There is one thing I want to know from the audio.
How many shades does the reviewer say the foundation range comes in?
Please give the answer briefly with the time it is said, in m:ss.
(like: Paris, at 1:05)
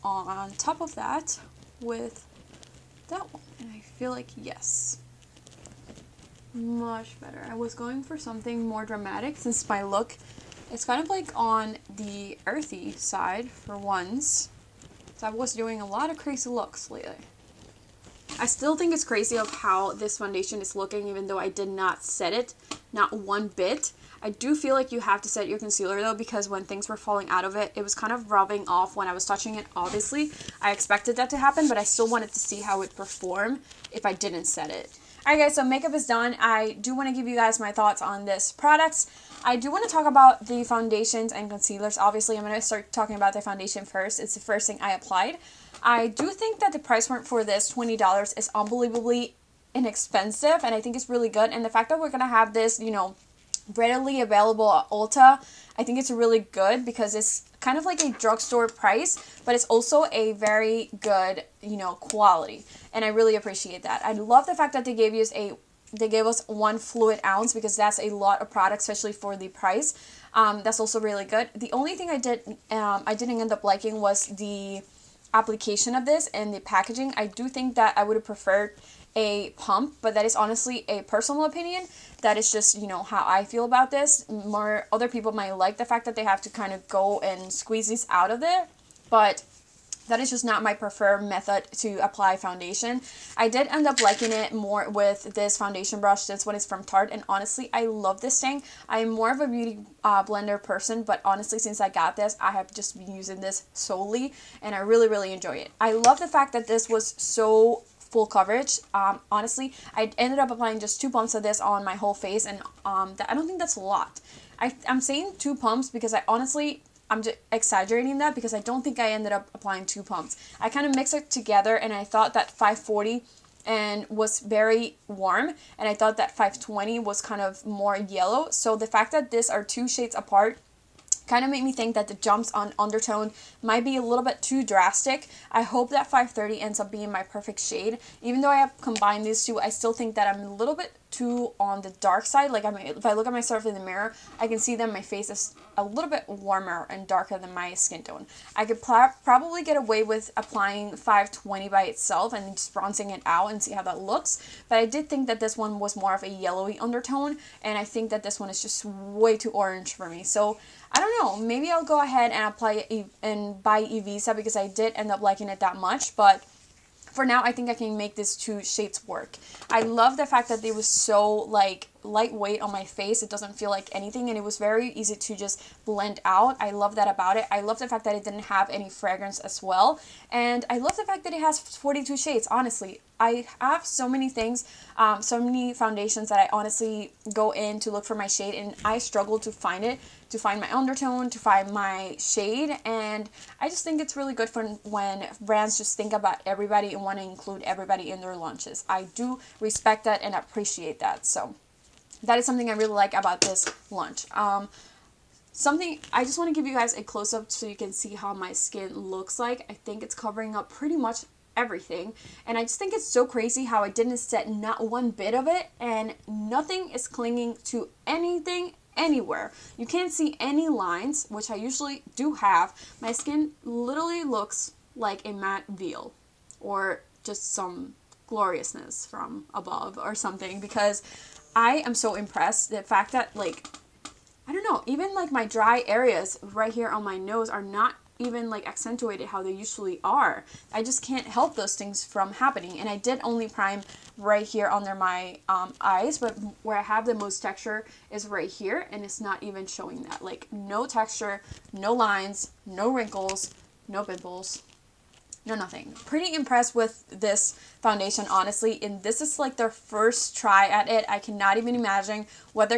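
42, at 3:01.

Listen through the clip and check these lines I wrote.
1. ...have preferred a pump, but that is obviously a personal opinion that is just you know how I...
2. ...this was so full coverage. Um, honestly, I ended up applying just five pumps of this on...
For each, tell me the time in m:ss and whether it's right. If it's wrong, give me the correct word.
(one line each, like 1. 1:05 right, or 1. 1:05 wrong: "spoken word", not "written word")
1. 1:18 wrong: "honestly", not "obviously"
2. 1:46 wrong: "two", not "five".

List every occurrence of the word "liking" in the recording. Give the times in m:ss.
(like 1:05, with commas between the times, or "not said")
1:13, 1:34, 2:45.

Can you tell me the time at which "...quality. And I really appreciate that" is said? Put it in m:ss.
1:01.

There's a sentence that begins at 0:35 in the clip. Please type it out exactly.
Alright guys, so makeup is done.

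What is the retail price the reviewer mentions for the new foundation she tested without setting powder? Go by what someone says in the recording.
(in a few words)
$20.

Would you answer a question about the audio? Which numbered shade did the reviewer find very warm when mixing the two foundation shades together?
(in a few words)
540.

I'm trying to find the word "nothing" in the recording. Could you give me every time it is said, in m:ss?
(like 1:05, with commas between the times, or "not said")
3:36, 4:15.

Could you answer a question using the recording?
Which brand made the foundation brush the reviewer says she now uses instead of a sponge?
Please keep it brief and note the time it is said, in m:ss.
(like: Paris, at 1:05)
Tarte, at 1:36.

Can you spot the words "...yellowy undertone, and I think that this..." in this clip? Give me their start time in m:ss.
2:36.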